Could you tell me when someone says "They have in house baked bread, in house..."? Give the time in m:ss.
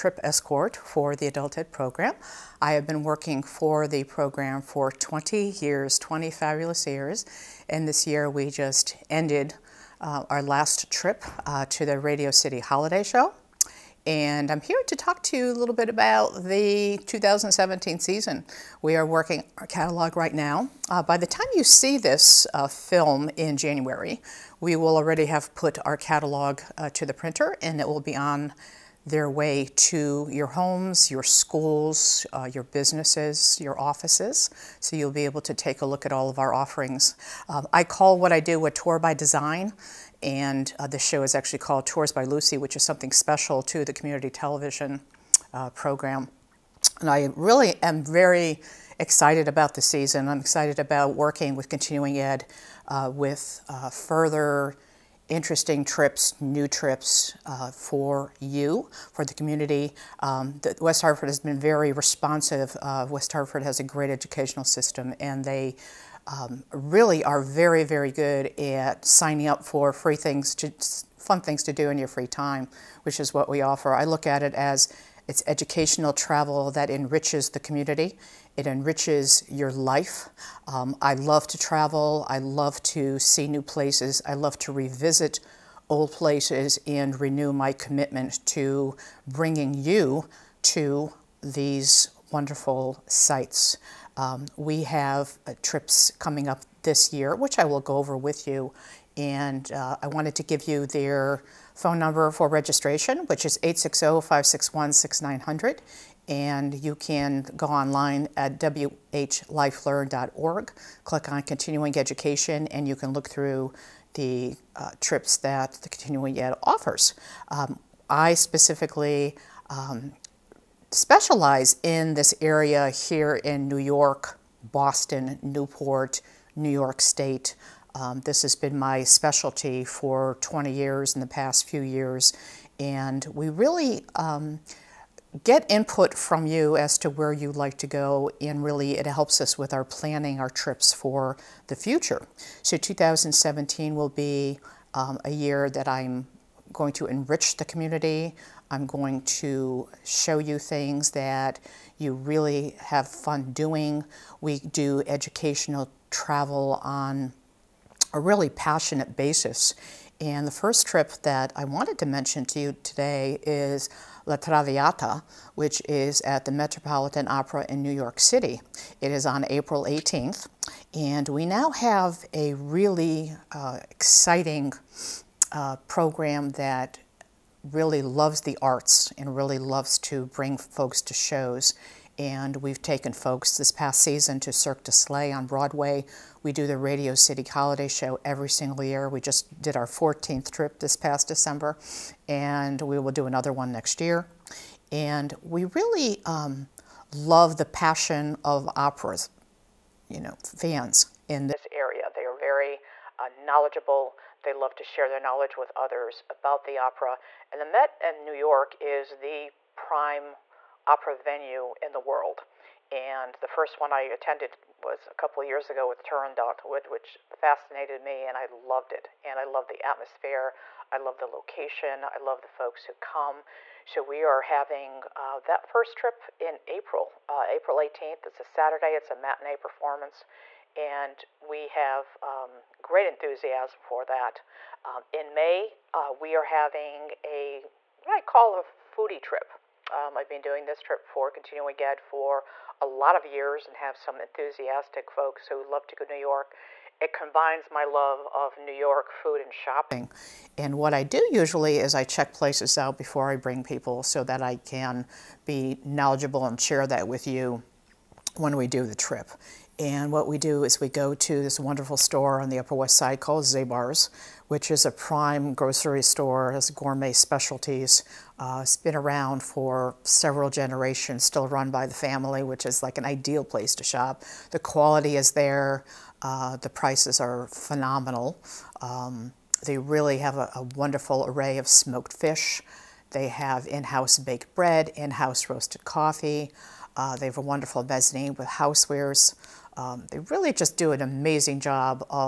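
4:43.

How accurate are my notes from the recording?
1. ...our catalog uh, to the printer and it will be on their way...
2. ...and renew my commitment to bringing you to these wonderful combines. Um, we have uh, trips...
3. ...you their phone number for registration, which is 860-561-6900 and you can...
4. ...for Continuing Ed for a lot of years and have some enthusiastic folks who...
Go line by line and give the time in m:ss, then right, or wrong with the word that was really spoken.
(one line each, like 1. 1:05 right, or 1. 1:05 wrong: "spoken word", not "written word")
1. 0:25 right
2. 1:26 wrong: "sites", not "combines"
3. 1:40 right
4. 4:01 right.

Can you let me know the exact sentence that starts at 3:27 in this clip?
And the Met in New York is the prime opera venue in the world.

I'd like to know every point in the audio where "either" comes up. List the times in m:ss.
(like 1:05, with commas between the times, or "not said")
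not said.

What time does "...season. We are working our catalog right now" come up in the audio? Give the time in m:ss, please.
0:17.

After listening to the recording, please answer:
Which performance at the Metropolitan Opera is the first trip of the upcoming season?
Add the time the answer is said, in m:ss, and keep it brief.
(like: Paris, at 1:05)
La Traviata, at 2:44.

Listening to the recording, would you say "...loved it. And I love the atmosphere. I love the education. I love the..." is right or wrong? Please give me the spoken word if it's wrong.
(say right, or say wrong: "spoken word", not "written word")
wrong: "location", not "education".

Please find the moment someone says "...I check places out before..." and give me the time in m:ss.
4:11.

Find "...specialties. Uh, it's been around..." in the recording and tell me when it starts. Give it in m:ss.
4:27.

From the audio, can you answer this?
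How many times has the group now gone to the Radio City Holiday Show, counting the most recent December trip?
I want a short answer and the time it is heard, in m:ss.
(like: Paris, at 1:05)
14, at 3:09.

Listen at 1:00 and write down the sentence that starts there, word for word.
Um, the, West Hartford has been very responsive.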